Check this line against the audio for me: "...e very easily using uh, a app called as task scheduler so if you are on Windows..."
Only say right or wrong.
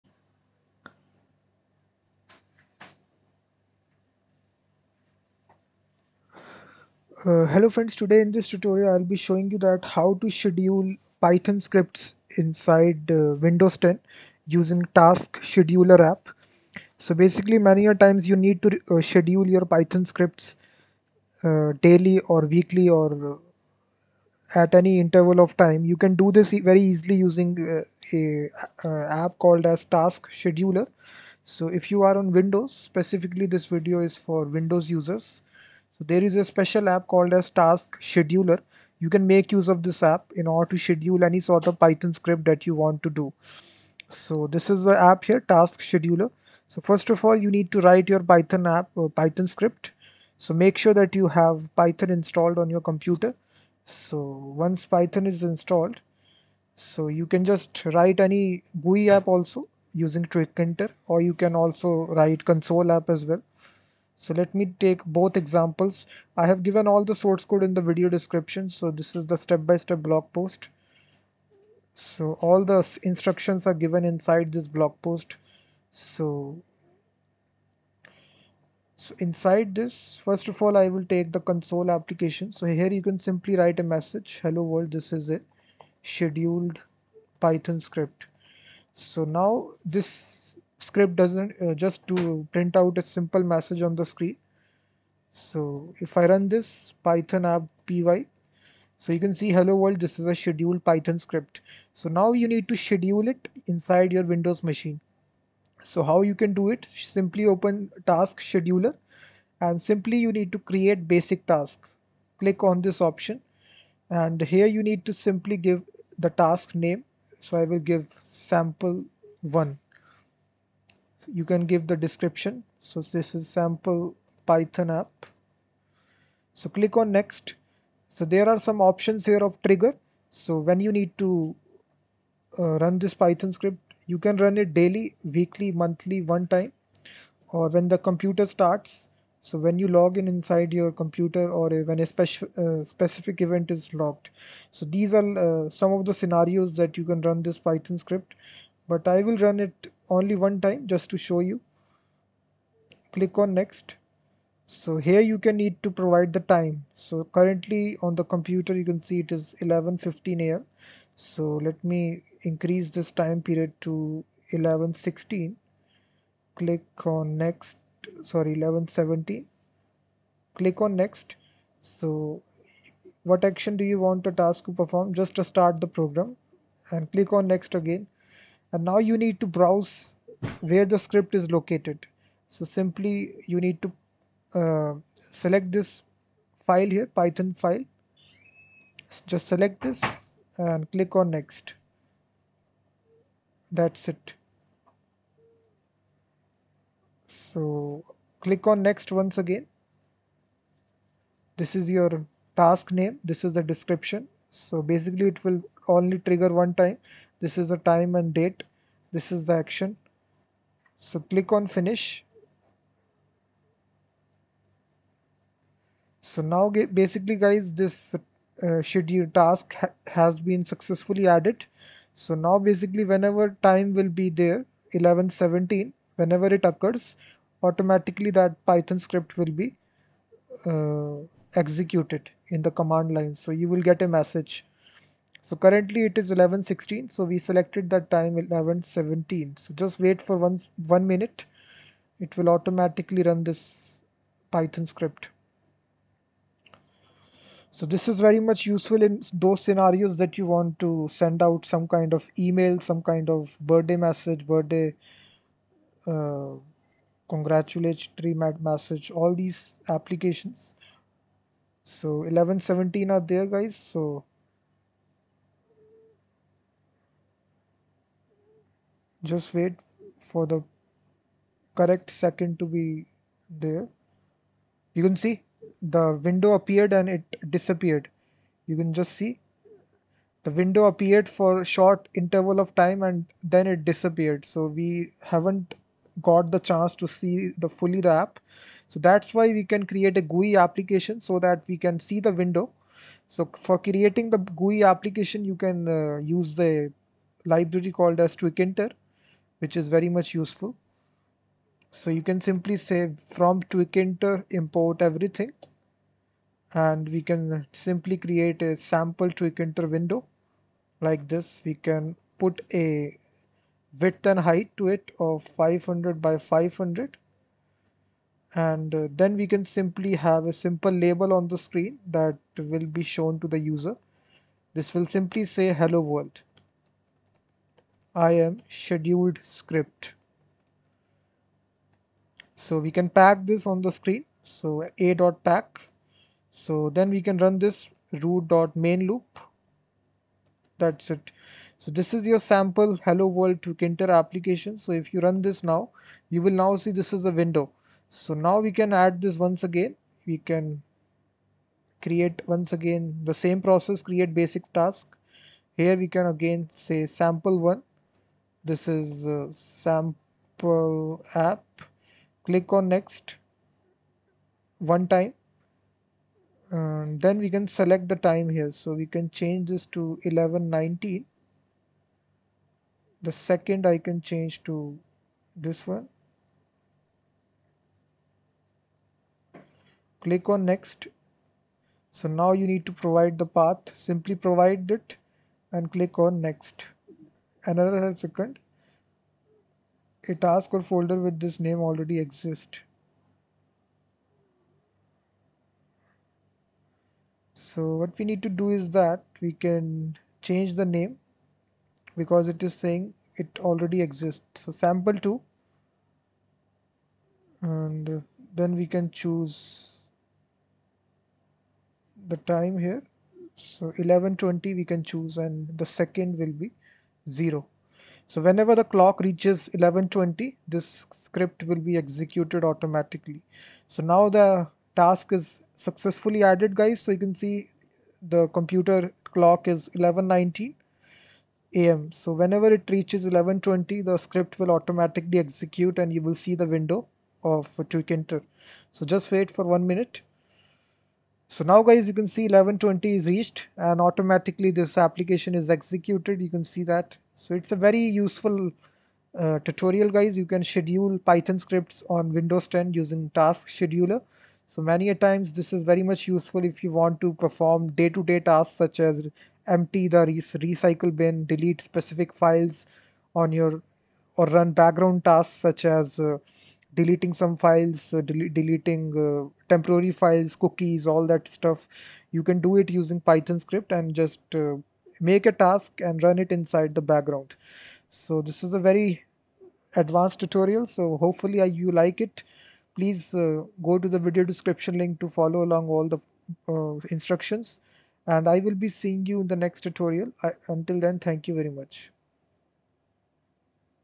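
right.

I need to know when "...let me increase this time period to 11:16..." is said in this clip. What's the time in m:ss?
2:41.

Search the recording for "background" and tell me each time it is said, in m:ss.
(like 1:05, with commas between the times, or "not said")
7:44, 7:57.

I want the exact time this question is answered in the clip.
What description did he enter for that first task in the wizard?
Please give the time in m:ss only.
2:03.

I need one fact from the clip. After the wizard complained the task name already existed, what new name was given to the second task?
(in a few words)
sample 2.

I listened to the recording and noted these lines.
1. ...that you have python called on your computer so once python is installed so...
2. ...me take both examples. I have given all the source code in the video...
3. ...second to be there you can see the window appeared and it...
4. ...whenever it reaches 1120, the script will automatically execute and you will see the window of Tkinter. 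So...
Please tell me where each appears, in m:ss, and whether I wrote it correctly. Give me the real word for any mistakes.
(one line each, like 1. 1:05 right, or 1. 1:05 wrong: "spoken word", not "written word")
1. 0:50 wrong: "installed", not "called"
2. 1:04 right
3. 4:32 right
4. 7:12 right.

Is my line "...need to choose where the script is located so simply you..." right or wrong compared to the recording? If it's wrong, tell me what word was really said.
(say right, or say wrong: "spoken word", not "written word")
wrong: "browse", not "choose".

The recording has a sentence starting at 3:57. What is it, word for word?
So we selected that time 11.17.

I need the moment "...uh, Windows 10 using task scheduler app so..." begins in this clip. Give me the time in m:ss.
0:13.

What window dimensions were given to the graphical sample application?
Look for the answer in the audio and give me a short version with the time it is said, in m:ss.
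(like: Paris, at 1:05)
500 by 500, at 5:15.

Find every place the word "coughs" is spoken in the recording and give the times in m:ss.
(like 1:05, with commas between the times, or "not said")
not said.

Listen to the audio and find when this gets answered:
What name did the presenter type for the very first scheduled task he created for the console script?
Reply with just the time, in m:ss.
1:58.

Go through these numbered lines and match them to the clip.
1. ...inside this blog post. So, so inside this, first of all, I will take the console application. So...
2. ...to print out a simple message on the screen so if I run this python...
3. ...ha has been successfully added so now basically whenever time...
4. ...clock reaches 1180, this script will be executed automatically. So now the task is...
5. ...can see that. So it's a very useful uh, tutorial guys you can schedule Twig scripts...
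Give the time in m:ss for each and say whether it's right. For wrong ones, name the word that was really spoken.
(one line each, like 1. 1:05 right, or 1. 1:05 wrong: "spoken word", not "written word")
1. 1:14 right
2. 1:32 right
3. 3:39 right
4. 6:58 wrong: "1120", not "1180"
5. 7:26 wrong: "Python", not "Twig".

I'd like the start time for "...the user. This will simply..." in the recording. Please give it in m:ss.
5:23.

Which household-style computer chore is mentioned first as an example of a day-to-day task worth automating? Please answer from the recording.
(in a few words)
empty the recycle bin.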